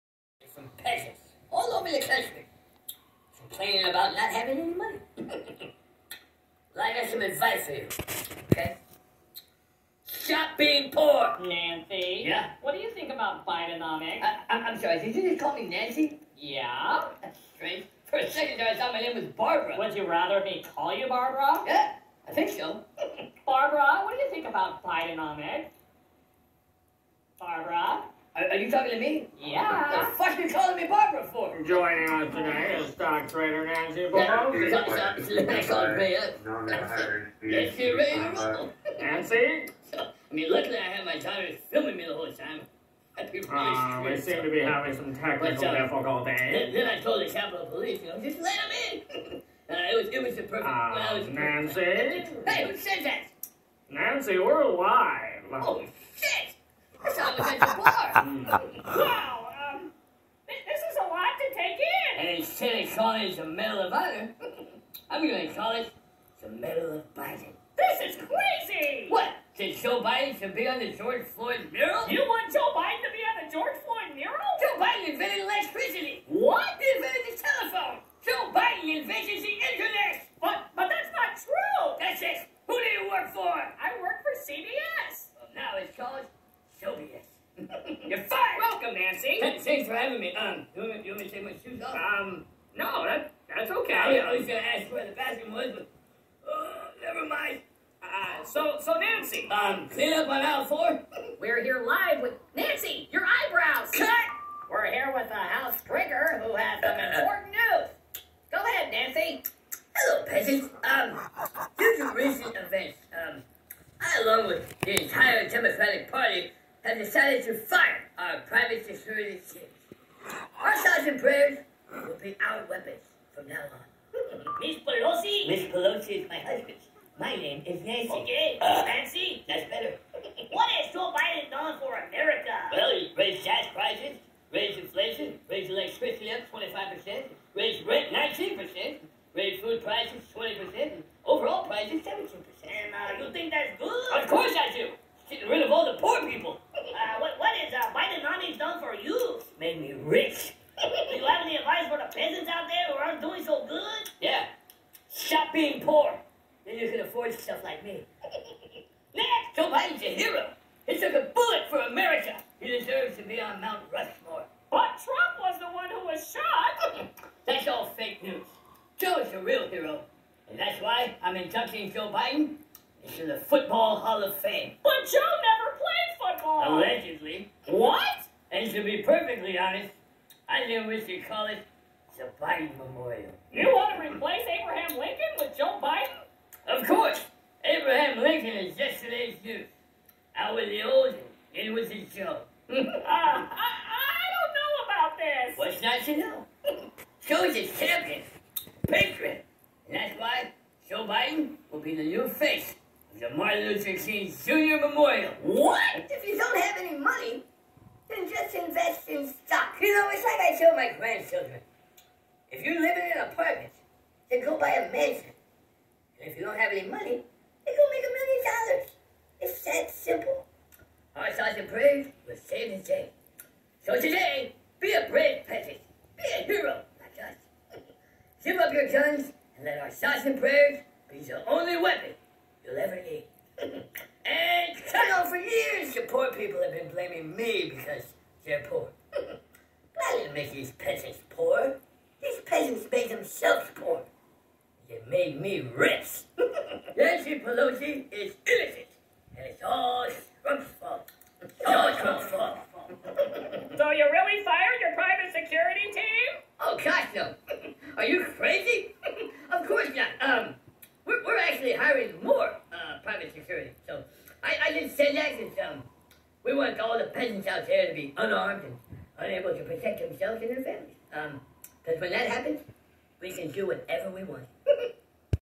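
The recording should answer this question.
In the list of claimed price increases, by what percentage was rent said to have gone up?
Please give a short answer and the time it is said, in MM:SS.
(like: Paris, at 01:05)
19%, at 02:17.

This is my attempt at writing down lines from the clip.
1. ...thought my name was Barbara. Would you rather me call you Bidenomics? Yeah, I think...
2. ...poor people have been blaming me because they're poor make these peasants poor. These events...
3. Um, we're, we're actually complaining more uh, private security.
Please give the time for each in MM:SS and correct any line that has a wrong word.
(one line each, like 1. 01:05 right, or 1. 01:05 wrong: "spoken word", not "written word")
1. 00:18 wrong: "Barbara", not "Bidenomics"
2. 03:56 wrong: "peasants", not "events"
3. 04:20 wrong: "hiring", not "complaining".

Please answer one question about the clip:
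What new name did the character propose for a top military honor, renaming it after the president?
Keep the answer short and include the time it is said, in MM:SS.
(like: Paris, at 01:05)
Medal of Biden, at 01:06.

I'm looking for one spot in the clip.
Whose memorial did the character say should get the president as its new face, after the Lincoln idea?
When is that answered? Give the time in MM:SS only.
03:23.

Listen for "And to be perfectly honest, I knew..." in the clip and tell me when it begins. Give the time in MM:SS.
02:58.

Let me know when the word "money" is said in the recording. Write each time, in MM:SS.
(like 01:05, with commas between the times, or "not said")
00:04, 03:26, 03:36.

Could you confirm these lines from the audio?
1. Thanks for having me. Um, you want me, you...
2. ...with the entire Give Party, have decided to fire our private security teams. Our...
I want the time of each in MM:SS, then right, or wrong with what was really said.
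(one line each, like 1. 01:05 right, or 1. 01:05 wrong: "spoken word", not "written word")
1. 01:29 right
2. 01:54 wrong: "Democratic", not "Give".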